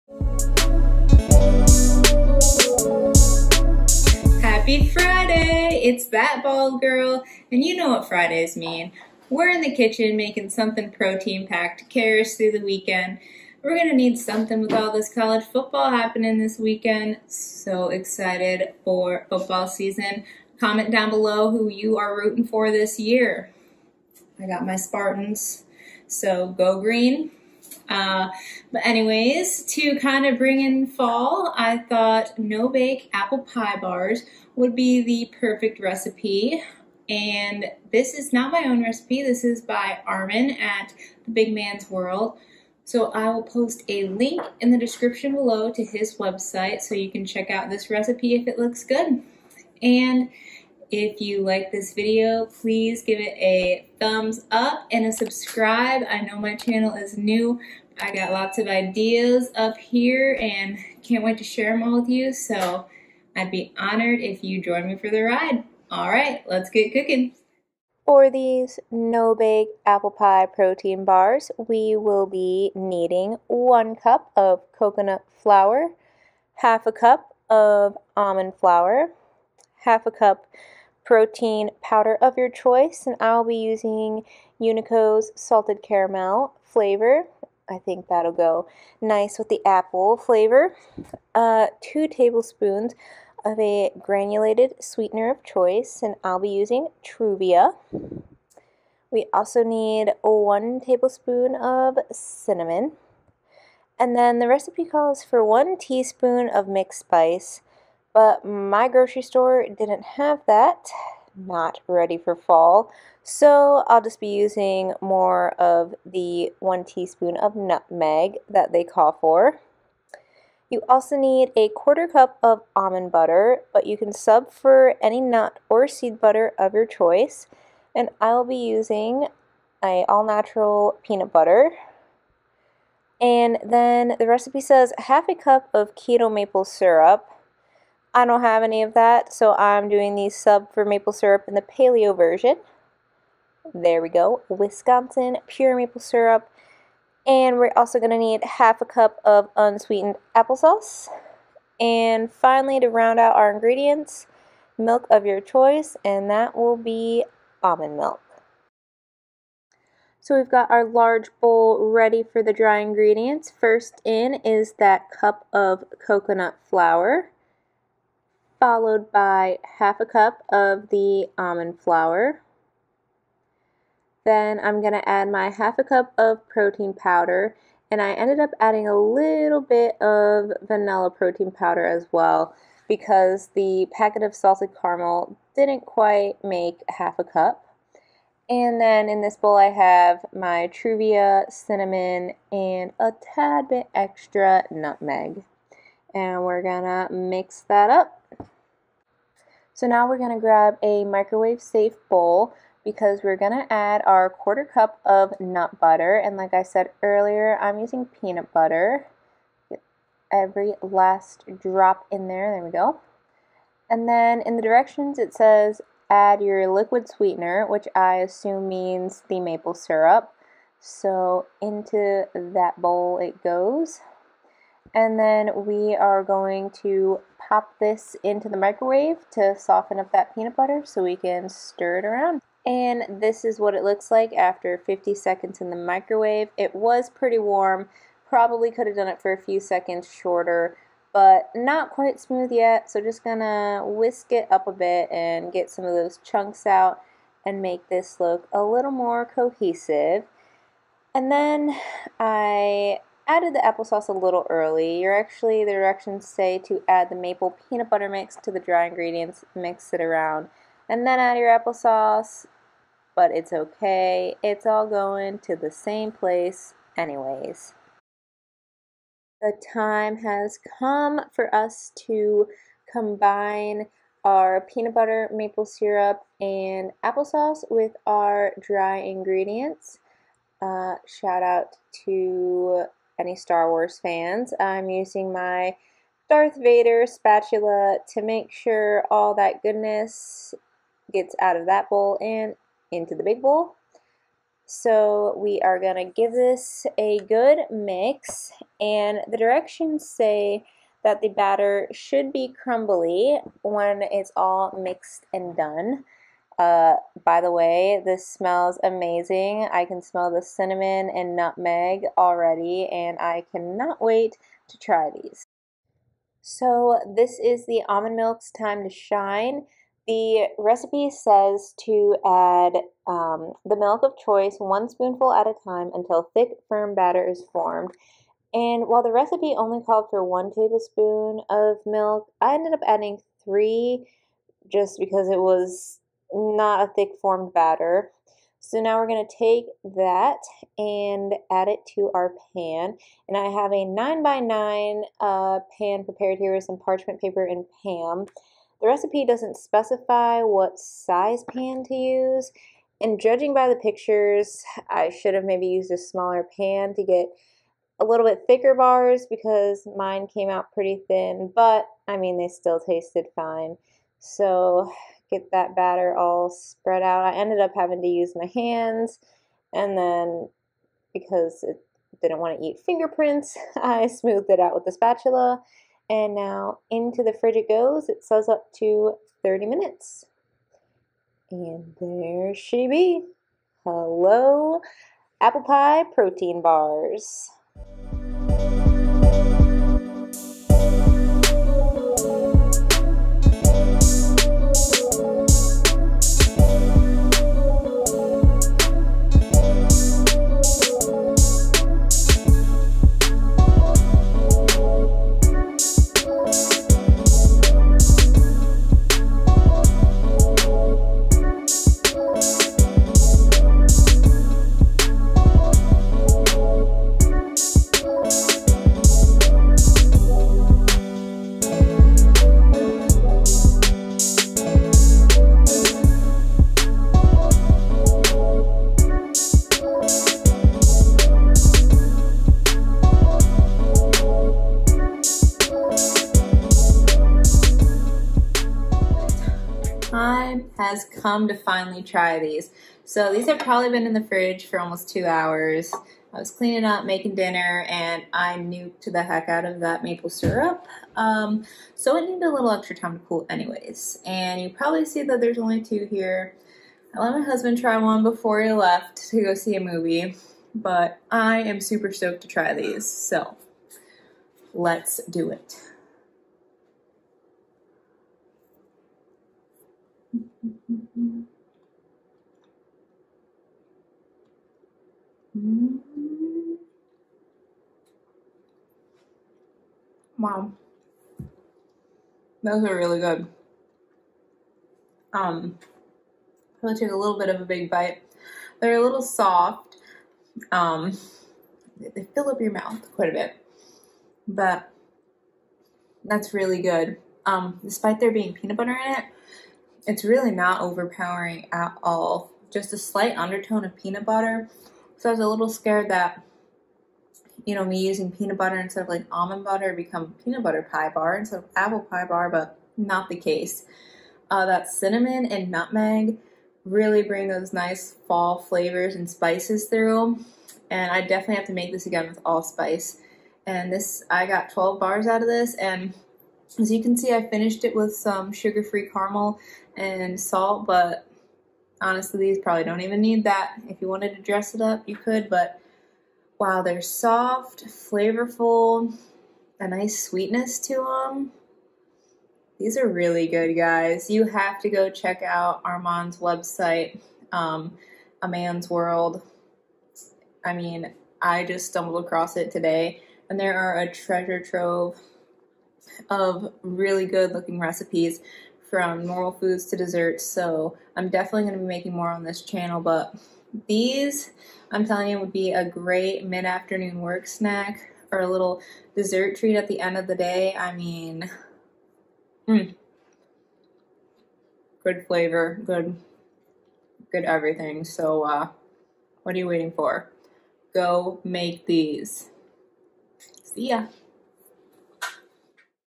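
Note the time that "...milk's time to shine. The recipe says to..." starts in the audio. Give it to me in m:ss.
5:18.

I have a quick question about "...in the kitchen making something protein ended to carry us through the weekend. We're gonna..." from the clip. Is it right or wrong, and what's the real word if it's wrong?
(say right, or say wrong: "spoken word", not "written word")
wrong: "packed", not "ended".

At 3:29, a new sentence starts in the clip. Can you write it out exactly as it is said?
Get every last drop in there.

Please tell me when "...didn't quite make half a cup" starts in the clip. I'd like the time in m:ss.
3:05.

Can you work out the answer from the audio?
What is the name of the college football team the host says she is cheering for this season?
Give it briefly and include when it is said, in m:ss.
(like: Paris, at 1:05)
Spartans, at 0:24.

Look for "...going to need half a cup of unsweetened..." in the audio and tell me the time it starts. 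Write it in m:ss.
2:27.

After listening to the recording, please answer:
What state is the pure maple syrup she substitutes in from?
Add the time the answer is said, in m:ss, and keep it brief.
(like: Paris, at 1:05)
Wisconsin, at 2:24.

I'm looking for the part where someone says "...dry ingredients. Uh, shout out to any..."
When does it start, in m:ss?
4:38.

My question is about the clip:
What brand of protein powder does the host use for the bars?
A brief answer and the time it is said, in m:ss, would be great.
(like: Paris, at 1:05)
Unico, at 1:24.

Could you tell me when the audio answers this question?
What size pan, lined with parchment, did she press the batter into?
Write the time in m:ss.
5:43.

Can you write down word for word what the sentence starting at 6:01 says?
But, I mean, they still tasted fine.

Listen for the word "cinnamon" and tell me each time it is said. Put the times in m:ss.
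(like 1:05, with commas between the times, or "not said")
1:42, 3:11, 5:10, 8:34.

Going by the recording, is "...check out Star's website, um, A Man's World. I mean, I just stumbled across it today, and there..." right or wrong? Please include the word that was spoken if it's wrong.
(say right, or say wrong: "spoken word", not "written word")
wrong: "Arman", not "Star".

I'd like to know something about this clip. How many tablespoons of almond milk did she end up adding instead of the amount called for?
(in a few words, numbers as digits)
3.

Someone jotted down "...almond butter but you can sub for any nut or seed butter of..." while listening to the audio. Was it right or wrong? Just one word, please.
right.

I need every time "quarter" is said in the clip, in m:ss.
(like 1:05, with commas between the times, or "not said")
2:01, 3:24.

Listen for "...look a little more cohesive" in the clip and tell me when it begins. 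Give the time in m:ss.
4:08.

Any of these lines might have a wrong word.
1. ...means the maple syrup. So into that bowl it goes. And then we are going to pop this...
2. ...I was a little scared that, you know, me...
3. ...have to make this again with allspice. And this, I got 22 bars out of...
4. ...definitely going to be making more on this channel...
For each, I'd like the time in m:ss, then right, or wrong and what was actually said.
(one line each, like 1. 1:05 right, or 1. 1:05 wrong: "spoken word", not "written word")
1. 3:38 right
2. 8:25 right
3. 8:41 wrong: "12", not "22"
4. 9:21 right.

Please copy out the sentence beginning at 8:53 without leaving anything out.
If you wanted to dress it up, you could, but wow, they're soft, flavorful, a nice sweetness to them.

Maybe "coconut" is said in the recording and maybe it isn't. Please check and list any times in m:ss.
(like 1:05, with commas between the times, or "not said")
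1:14, 2:46.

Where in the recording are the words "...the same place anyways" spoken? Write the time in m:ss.
4:25.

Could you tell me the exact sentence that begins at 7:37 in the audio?
I let my husband try one before he left to go see a movie, but I am super stoked to try these.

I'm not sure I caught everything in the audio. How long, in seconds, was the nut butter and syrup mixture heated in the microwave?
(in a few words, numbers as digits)
50 seconds.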